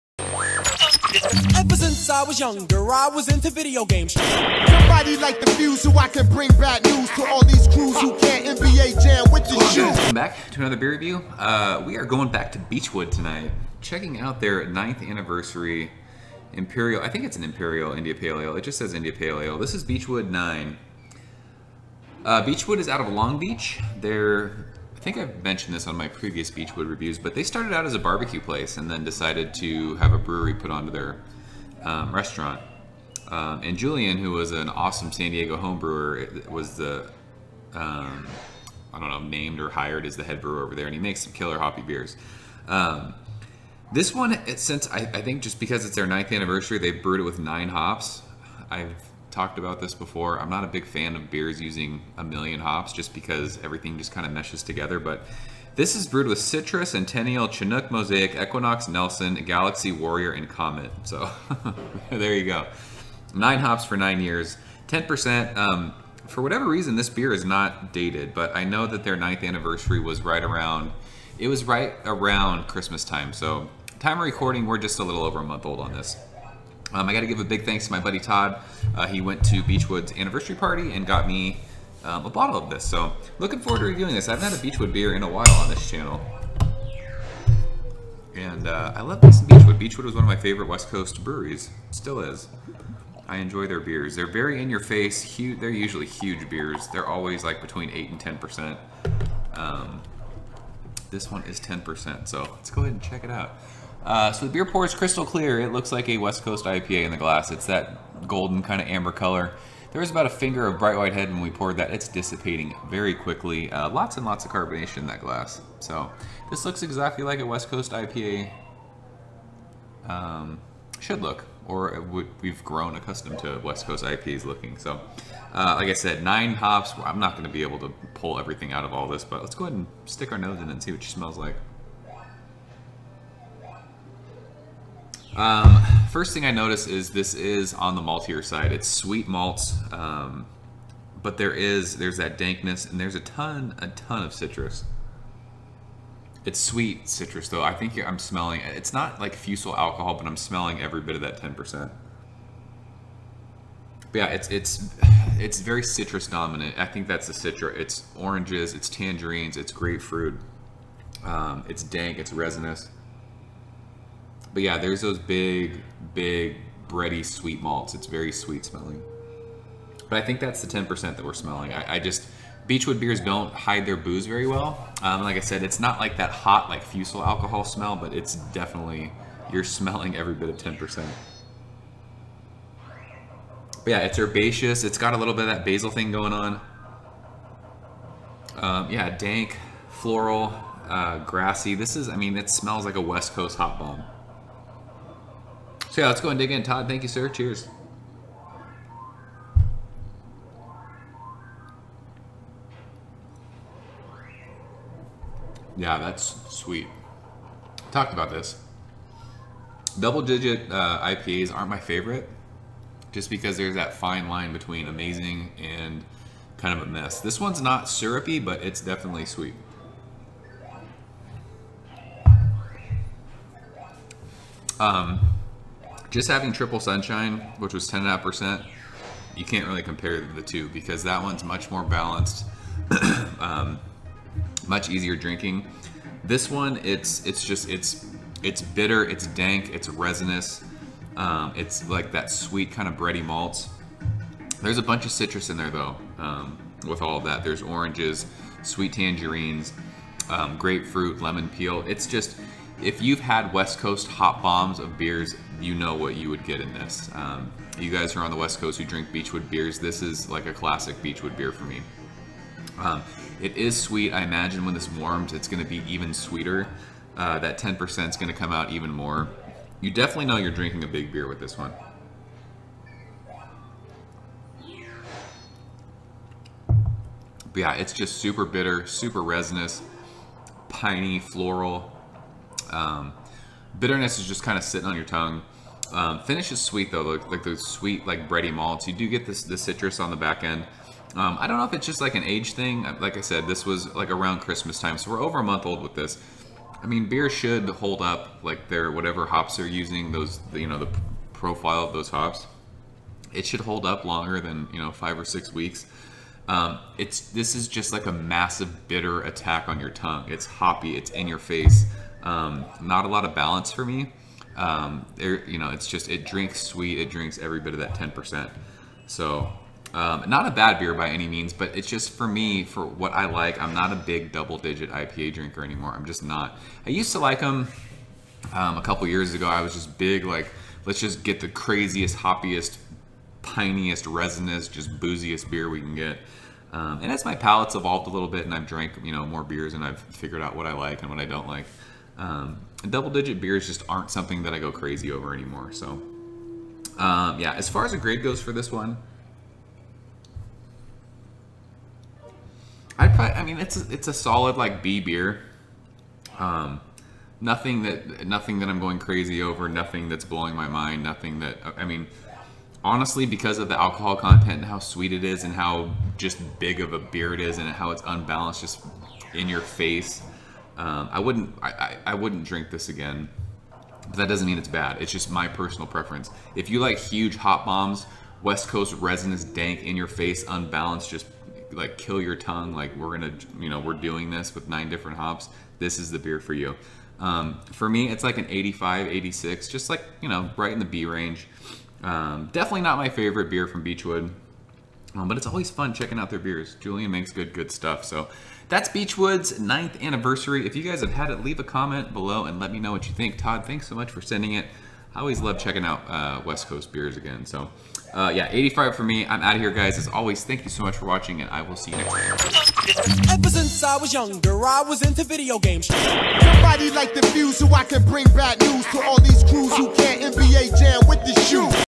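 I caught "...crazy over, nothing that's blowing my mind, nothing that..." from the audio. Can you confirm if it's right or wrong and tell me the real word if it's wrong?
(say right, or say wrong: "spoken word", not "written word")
right.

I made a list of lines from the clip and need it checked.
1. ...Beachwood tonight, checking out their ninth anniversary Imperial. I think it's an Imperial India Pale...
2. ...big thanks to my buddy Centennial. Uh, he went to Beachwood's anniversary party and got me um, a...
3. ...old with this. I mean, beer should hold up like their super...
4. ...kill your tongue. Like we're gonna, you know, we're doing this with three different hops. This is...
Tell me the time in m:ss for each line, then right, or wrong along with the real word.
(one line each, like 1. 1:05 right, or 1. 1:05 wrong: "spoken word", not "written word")
1. 0:12 right
2. 1:17 wrong: "Todd", not "Centennial"
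3. 4:55 wrong: "whatever", not "super"
4. 6:21 wrong: "nine", not "three".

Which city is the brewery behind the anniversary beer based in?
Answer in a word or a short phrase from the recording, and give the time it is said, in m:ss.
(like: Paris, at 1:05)
Long Beach, at 0:23.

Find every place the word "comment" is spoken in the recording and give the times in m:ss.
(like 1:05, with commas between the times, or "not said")
6:41.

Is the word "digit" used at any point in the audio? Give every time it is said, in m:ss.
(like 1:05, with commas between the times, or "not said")
3:30, 5:24, 5:43.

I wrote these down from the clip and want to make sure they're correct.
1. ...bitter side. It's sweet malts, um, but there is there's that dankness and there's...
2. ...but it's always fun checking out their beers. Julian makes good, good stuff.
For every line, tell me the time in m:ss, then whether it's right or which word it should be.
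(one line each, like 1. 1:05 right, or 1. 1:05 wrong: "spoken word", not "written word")
1. 2:18 wrong: "maltier", not "bitter"
2. 6:35 right.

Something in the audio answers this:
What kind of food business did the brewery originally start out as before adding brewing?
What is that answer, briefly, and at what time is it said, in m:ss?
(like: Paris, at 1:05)
Barbecue place, at 0:27.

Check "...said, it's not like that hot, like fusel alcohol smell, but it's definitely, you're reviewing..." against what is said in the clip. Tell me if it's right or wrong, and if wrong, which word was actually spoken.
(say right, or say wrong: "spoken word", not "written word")
wrong: "smelling", not "reviewing".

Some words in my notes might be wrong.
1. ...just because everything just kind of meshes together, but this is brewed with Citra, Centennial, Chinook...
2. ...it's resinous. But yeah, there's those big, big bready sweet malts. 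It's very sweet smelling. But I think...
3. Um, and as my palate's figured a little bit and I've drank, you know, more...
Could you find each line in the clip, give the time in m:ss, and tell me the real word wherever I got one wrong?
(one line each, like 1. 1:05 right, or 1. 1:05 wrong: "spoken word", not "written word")
1. 0:52 right
2. 2:42 right
3. 5:36 wrong: "evolved", not "figured".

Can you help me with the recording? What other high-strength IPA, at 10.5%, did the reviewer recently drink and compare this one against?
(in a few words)
Triple Sunshine.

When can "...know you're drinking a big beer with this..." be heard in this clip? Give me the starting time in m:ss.
4:30.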